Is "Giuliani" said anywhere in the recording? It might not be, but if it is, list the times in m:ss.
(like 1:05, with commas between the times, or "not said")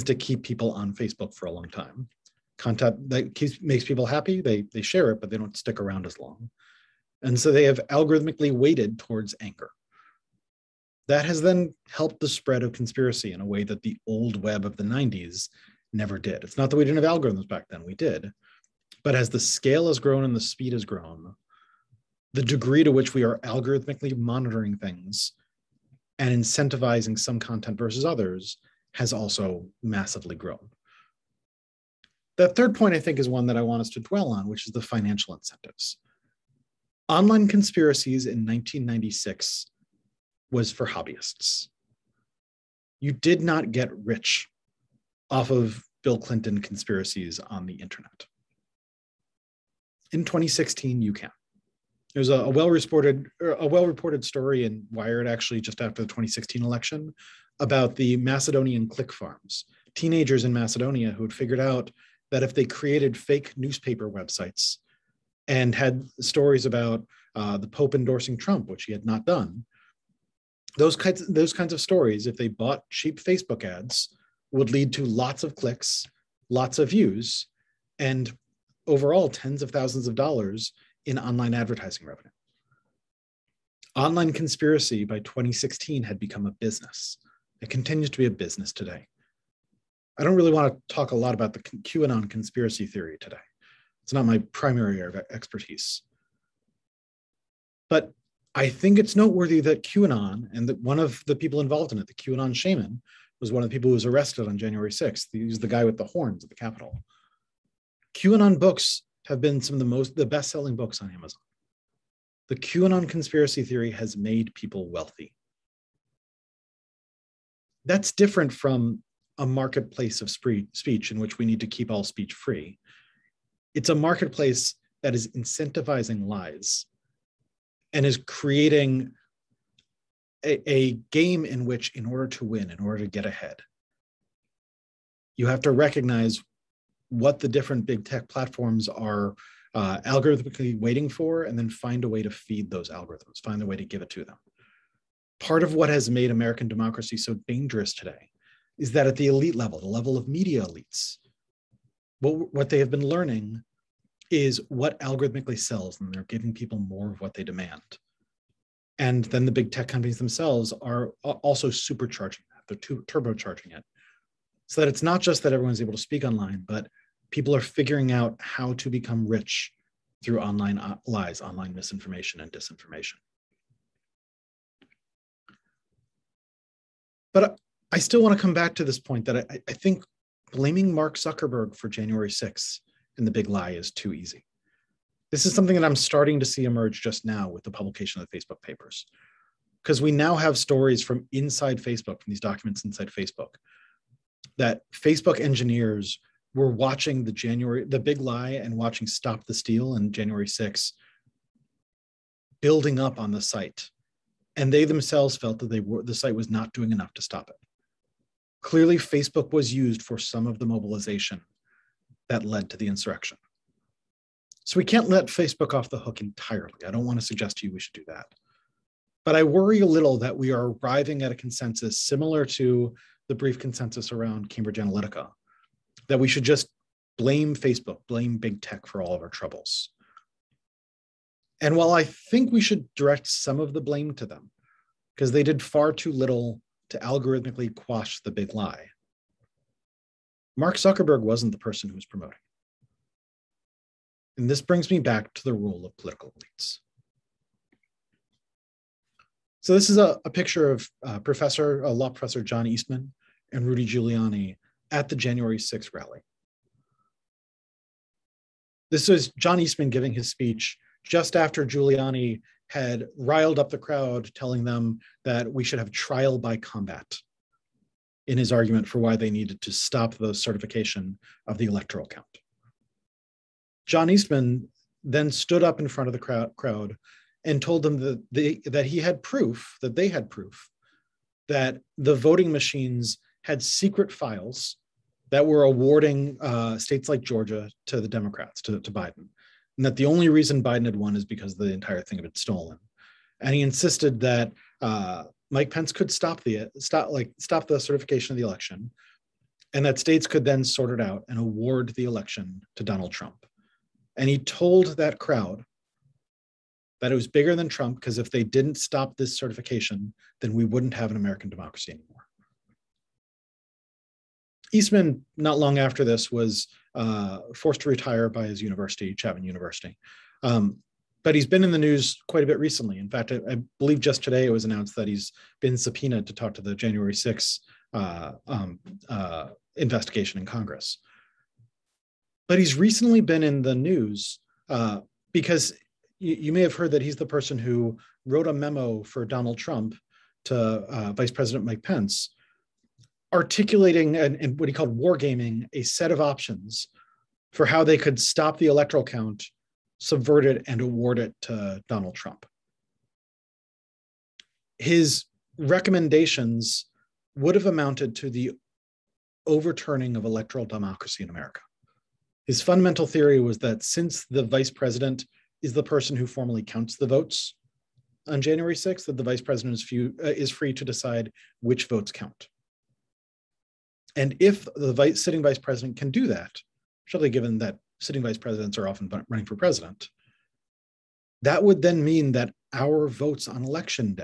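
4:13, 4:21.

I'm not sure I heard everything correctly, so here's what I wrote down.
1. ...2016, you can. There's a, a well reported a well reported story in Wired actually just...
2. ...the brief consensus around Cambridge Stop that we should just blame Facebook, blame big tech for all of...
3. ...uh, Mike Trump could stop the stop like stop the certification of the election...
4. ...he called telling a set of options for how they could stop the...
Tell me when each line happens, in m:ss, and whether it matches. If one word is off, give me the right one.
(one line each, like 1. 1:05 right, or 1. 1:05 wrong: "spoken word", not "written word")
1. 0:50 right
2. 3:43 wrong: "Analytica", not "Stop"
3. 4:54 wrong: "Pence", not "Trump"
4. 5:44 wrong: "wargaming", not "telling".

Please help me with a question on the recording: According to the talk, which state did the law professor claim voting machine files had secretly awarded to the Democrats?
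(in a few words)
Georgia.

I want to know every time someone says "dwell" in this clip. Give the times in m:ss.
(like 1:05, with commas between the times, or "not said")
0:34.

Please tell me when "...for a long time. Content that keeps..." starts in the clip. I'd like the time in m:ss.
0:01.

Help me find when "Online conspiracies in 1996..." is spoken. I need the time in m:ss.
0:37.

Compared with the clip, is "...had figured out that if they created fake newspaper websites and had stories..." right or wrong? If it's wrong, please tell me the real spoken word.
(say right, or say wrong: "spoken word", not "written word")
right.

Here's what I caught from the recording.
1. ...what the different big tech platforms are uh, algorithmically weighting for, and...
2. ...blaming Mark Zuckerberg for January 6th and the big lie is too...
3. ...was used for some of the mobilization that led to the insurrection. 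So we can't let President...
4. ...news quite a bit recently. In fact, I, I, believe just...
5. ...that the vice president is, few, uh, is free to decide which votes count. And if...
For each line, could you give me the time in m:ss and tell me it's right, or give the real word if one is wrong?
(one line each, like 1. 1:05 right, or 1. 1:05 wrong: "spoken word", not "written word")
1. 2:17 right
2. 3:00 right
3. 3:29 wrong: "Facebook", not "President"
4. 5:21 right
5. 6:09 right.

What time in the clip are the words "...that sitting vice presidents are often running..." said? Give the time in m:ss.
6:17.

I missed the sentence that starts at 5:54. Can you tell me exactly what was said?
His recommendations would have amounted to the overturning of electoral democracy in America.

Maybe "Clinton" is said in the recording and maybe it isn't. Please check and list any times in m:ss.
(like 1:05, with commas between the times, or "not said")
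0:46.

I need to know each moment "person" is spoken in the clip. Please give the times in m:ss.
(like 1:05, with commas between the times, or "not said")
4:01, 5:37, 6:05.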